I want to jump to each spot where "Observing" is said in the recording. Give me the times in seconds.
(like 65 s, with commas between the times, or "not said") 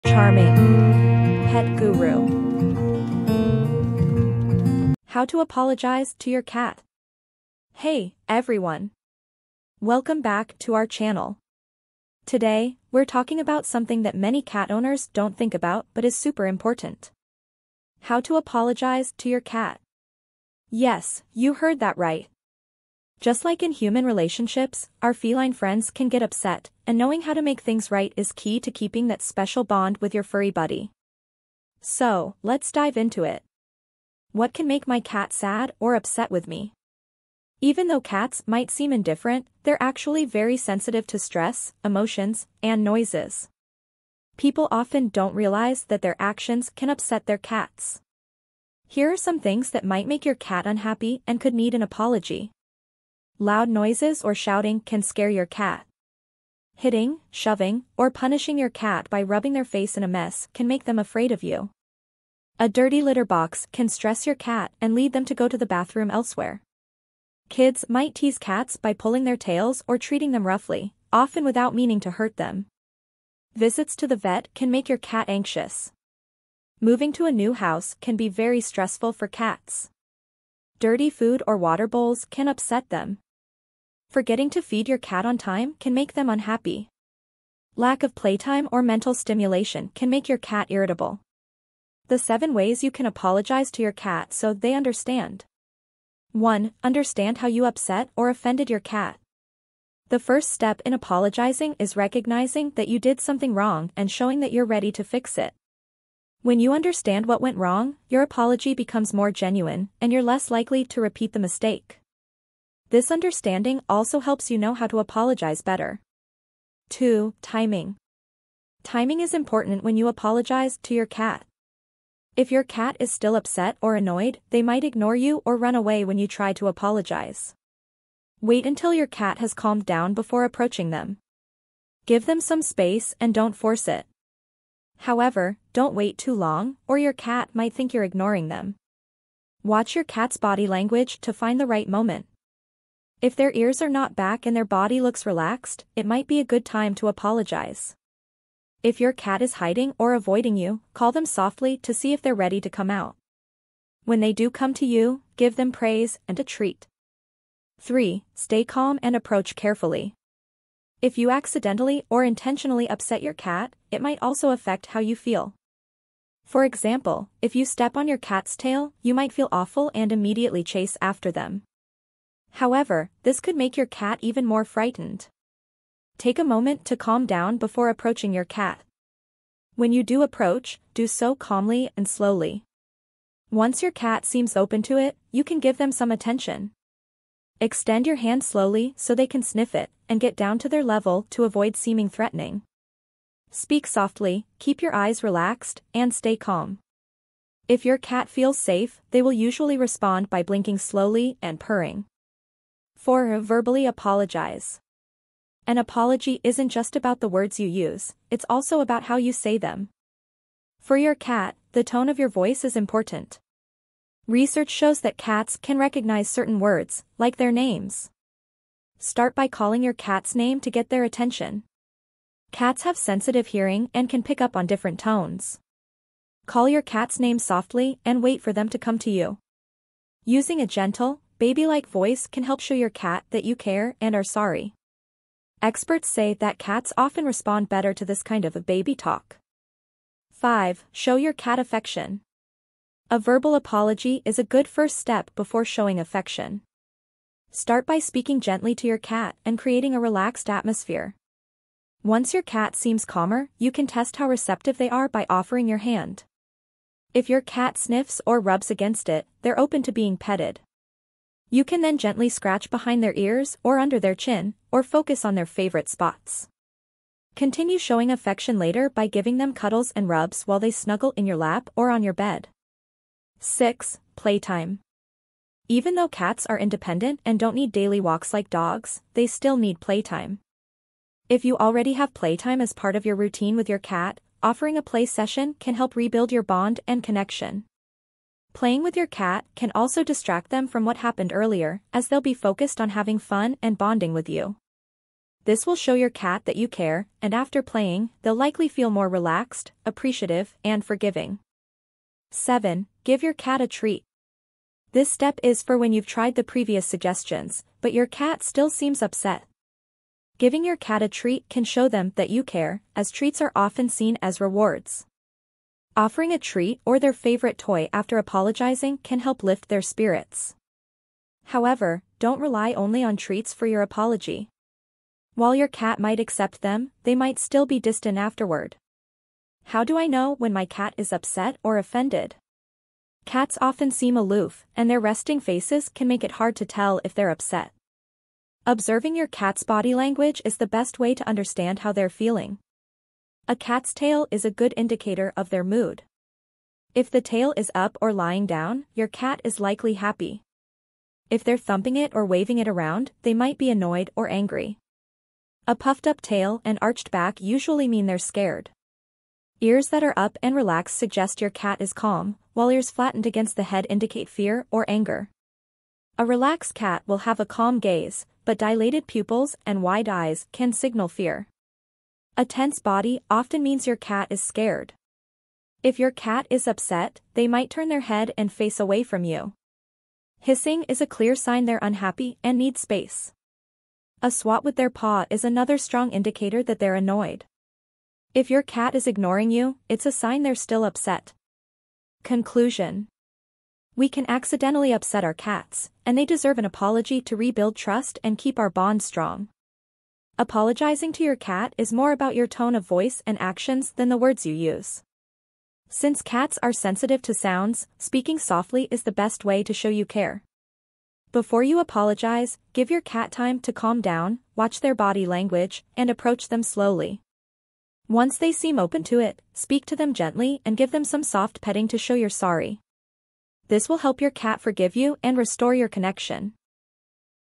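338 s.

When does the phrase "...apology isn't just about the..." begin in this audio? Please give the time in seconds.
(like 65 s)
205 s.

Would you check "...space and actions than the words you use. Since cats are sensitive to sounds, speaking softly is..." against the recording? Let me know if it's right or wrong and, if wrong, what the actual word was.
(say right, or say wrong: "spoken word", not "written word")
wrong: "voice", not "space".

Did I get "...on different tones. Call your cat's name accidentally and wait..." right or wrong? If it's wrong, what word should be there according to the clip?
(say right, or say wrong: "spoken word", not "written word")
wrong: "softly", not "accidentally".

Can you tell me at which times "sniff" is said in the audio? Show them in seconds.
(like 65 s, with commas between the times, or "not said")
189 s, 257 s.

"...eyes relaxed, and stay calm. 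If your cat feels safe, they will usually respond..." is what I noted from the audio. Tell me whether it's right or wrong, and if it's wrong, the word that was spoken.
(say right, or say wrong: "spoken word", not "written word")
right.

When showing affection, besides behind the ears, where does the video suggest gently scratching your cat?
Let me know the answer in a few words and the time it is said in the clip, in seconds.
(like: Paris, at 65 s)
under their chin, at 263 s.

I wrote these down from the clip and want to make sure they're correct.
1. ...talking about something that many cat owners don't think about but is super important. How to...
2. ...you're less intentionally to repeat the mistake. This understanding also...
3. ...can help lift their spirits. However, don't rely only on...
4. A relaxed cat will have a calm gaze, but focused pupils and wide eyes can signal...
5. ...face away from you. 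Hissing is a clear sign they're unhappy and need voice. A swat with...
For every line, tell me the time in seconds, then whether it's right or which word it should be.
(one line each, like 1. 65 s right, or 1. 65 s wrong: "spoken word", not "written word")
1. 13 s right
2. 110 s wrong: "likely", not "intentionally"
3. 318 s right
4. 366 s wrong: "dilated", not "focused"
5. 378 s wrong: "space", not "voice".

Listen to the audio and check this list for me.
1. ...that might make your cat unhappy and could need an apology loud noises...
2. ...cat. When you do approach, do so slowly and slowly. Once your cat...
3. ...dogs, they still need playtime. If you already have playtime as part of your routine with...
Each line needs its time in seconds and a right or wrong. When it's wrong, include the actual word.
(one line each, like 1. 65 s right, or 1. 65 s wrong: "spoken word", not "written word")
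1. 49 s right
2. 178 s wrong: "calmly", not "slowly"
3. 278 s right.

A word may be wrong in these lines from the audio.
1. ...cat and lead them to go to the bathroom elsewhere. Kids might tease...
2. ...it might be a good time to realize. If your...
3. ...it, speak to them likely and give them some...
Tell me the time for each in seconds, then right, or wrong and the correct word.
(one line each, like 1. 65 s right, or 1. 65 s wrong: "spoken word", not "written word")
1. 64 s right
2. 145 s wrong: "apologize", not "realize"
3. 419 s wrong: "gently", not "likely".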